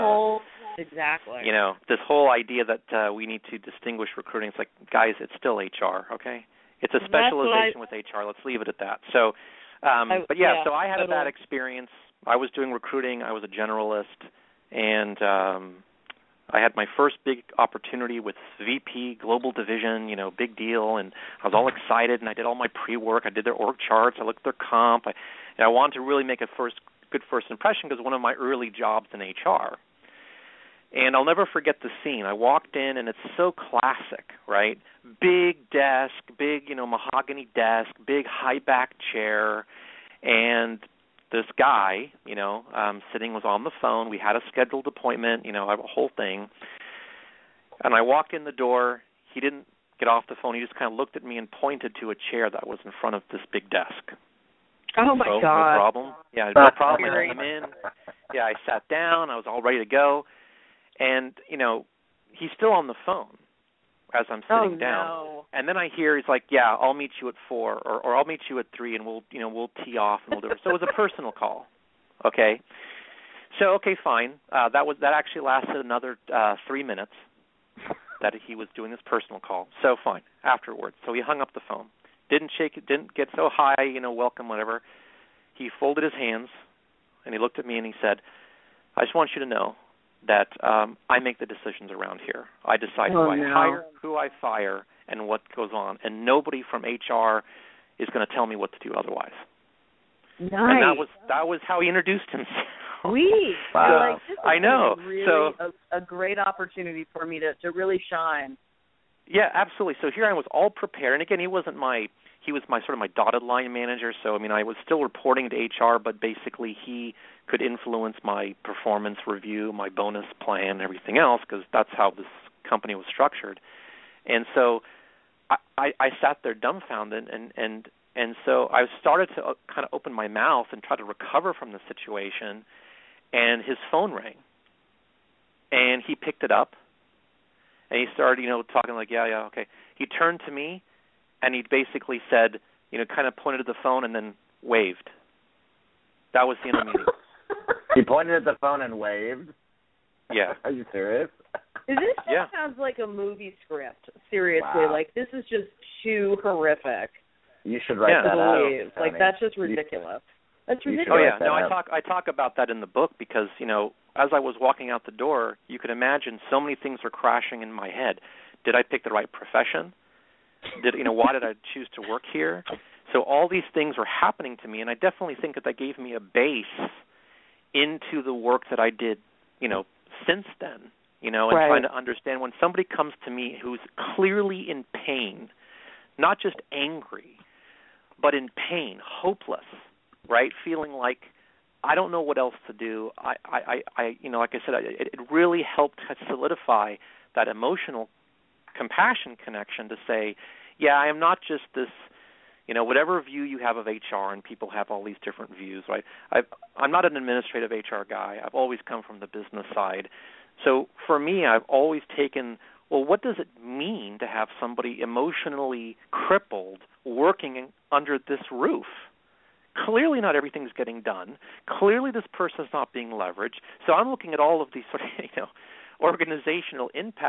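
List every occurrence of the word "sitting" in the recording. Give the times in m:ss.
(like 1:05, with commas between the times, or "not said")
0:43, 1:04.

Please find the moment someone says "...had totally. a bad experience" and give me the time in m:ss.
0:10.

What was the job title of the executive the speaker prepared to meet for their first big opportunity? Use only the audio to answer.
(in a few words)
VP Global Division.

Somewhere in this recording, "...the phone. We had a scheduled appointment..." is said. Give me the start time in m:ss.
0:43.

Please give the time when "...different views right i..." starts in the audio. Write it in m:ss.
3:25.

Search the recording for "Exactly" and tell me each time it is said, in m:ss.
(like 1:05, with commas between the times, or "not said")
0:00.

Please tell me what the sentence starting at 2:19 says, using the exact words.
He turned to me, and he basically said, you know, kind of pointed to the phone and then waved.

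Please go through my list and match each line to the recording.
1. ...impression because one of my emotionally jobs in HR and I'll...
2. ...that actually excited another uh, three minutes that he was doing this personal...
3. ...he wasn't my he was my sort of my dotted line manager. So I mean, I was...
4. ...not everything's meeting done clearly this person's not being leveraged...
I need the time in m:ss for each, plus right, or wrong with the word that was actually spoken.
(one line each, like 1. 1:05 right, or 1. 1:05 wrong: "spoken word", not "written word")
1. 0:27 wrong: "early", not "emotionally"
2. 1:15 wrong: "lasted", not "excited"
3. 1:51 right
4. 3:40 wrong: "getting", not "meeting".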